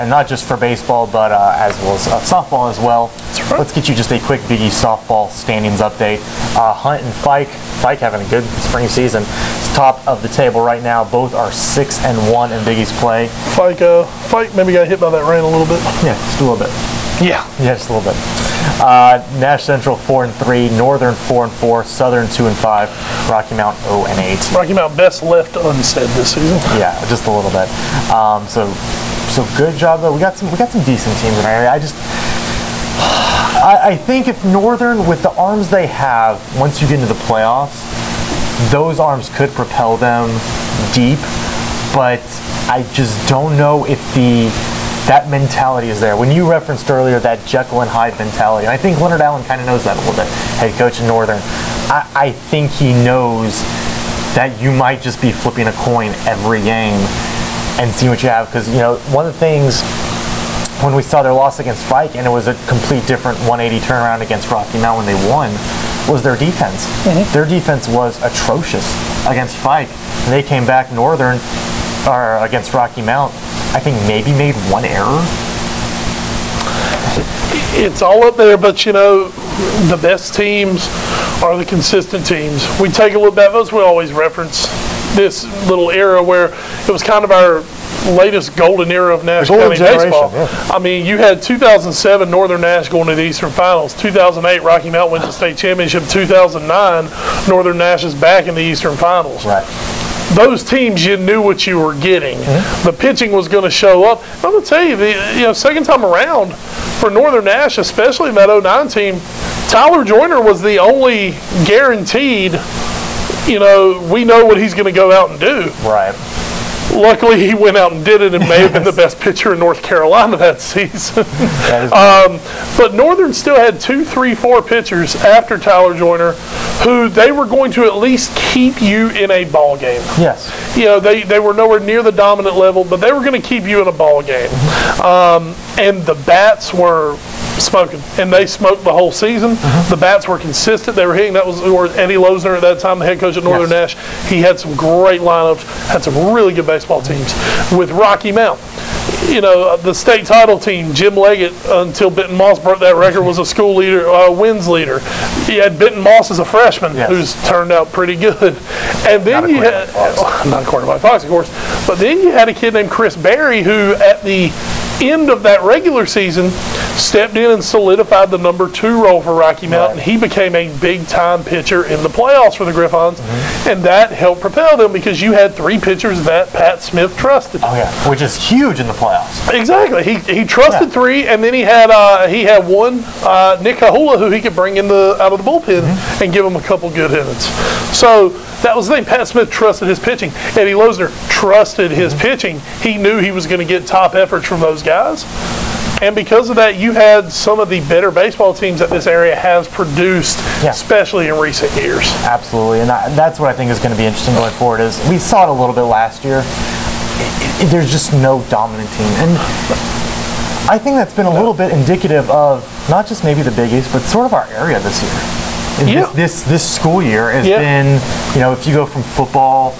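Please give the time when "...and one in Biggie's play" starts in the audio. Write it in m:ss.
0:12.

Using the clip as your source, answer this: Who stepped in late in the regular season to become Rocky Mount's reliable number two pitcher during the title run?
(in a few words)
Chris Berry.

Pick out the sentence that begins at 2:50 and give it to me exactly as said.
He became a big time pitcher in the playoffs for the Gryphons, mm-hmm.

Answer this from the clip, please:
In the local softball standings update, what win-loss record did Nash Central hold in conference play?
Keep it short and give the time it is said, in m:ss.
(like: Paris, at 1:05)
4 and 3, at 0:19.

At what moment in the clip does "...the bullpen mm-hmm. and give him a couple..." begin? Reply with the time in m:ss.
3:05.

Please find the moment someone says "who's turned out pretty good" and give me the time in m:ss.
2:37.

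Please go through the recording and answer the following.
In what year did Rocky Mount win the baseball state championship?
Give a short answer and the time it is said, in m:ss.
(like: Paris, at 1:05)
2008, at 1:33.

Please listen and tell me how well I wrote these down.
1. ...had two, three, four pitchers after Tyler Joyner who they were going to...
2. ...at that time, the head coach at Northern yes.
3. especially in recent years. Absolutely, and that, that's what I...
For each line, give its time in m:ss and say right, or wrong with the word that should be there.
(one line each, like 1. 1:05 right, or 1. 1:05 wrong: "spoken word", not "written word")
1. 2:03 right
2. 2:22 right
3. 3:20 right.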